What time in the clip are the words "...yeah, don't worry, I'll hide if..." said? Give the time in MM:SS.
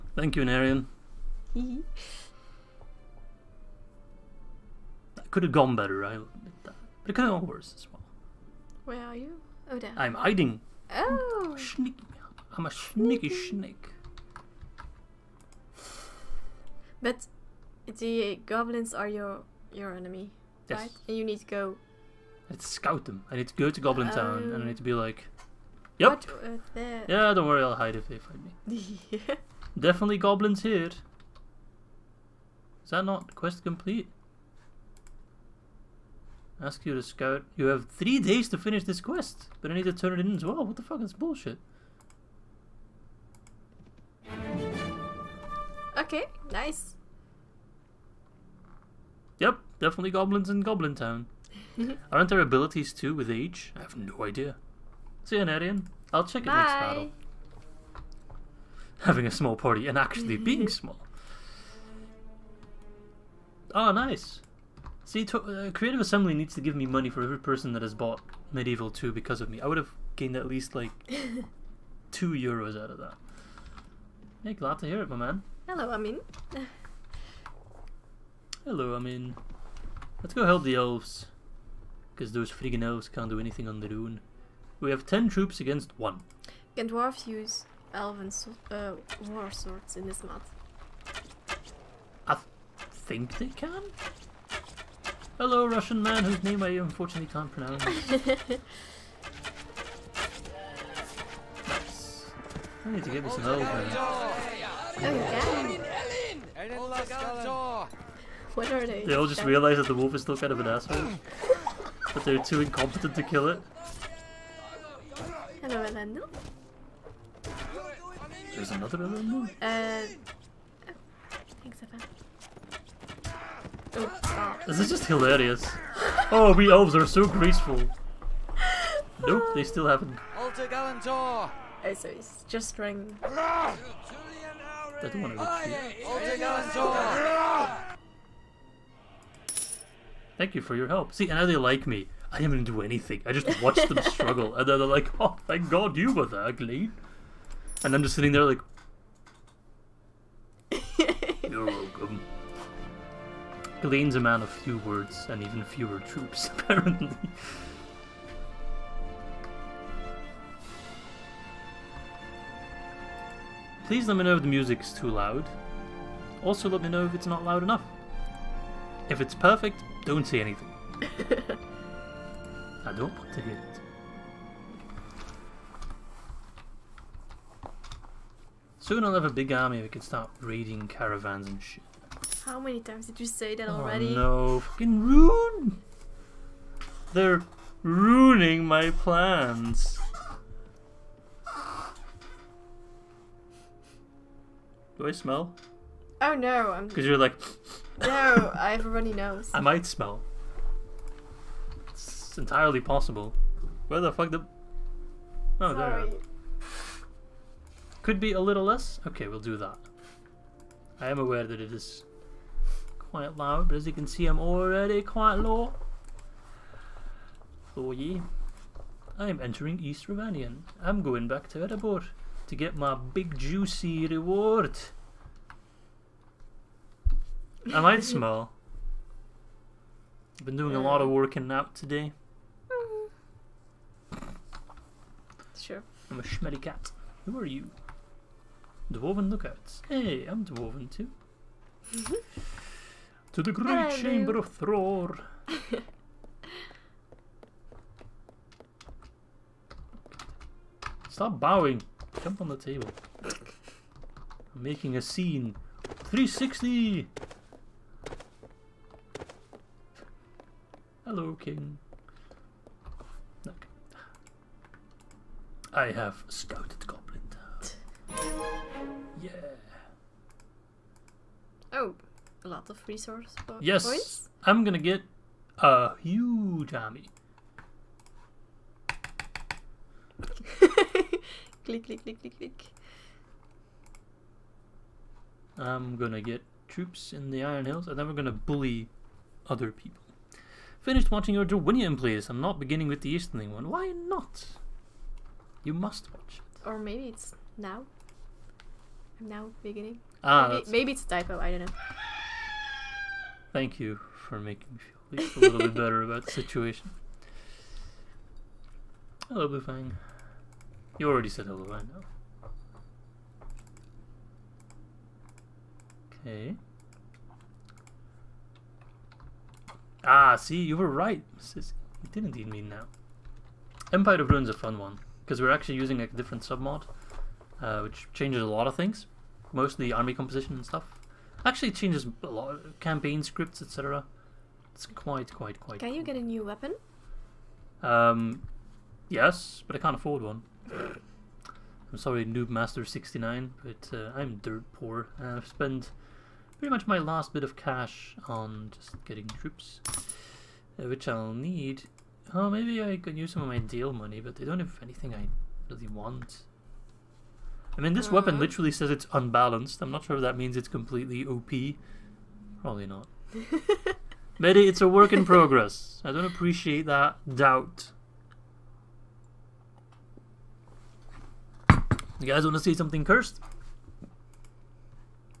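00:27.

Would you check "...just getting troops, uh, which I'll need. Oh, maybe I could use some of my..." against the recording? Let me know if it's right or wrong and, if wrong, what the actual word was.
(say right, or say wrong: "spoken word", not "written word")
right.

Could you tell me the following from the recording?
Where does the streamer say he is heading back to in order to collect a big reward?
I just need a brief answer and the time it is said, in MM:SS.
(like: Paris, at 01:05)
Erebor, at 03:41.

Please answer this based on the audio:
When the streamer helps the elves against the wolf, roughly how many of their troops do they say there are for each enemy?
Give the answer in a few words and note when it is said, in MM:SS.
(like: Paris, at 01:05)
10, at 01:25.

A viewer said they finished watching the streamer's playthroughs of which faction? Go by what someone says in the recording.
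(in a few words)
Dorwinion.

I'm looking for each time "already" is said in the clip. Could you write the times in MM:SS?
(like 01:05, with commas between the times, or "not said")
03:03, 03:34, 05:11.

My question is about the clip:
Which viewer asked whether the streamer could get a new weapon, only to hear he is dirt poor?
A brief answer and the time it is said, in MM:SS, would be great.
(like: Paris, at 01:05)
Noob Master 69, at 05:42.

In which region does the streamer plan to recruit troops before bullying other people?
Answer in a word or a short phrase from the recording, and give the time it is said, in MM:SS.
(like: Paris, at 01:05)
Iron Hills, at 04:47.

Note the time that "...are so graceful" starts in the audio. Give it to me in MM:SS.
02:06.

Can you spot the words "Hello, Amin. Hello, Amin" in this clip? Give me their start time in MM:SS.
01:15.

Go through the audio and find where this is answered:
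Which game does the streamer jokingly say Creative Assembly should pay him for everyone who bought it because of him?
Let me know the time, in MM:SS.
01:08.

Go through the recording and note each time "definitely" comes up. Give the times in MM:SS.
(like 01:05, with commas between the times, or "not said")
00:29, 00:49.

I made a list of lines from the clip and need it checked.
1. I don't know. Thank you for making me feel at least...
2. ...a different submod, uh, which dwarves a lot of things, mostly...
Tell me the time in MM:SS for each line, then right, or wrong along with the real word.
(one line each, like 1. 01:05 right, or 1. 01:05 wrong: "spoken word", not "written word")
1. 05:01 right
2. 05:26 wrong: "changes", not "dwarves".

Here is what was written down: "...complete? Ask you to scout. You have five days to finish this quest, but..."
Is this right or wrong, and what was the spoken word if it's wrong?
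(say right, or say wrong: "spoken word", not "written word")
wrong: "three", not "five".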